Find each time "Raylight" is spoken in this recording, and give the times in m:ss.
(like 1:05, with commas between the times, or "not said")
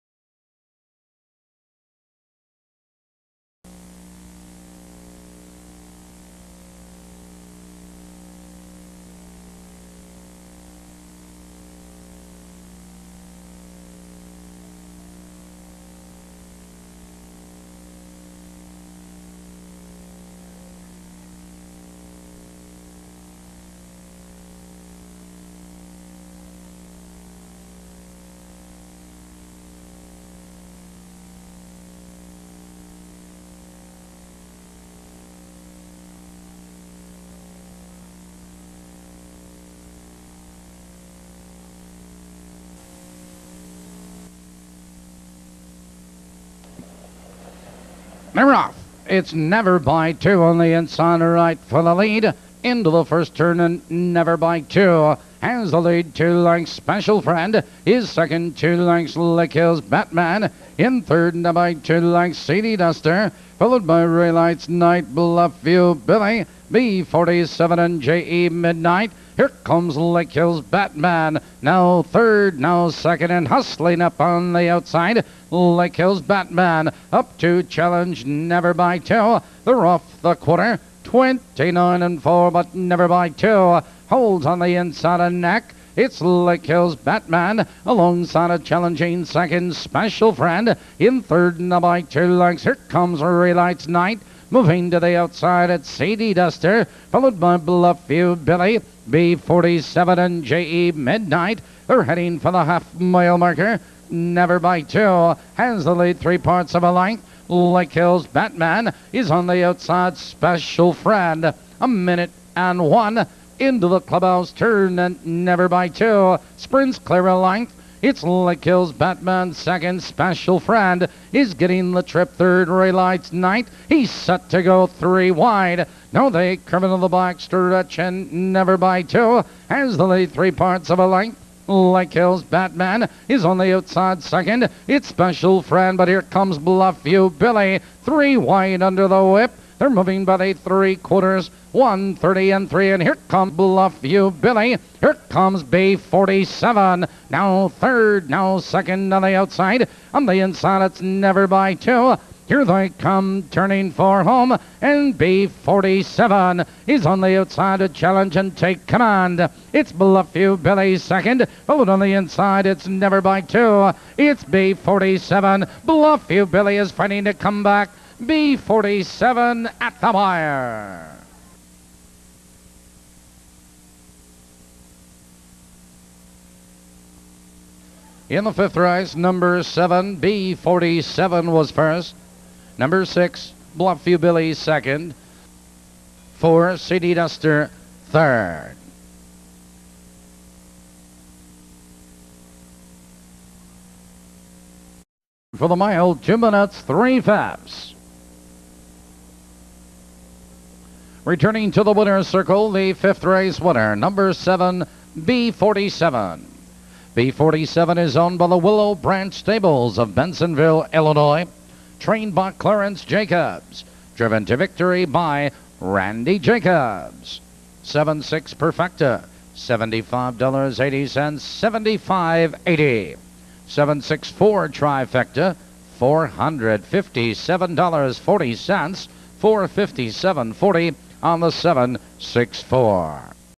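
1:04.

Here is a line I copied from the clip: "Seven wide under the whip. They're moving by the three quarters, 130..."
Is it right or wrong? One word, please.
wrong.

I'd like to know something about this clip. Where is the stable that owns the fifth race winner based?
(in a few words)
Bensenville, Illinois.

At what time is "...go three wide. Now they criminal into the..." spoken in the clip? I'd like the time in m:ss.
2:04.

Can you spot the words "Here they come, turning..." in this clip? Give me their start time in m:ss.
2:32.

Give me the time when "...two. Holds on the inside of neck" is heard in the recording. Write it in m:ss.
1:23.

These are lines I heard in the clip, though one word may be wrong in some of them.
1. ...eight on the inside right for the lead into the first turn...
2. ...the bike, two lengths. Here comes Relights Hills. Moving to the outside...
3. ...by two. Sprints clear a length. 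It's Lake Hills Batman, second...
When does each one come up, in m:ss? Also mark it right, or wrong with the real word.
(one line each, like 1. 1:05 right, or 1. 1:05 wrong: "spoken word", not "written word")
1. 0:50 wrong: "two", not "eight"
2. 1:31 wrong: "Knight", not "Hills"
3. 1:55 right.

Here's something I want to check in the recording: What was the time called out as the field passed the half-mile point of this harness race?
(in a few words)
1:01.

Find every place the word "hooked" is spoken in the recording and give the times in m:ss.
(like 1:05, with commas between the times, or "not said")
not said.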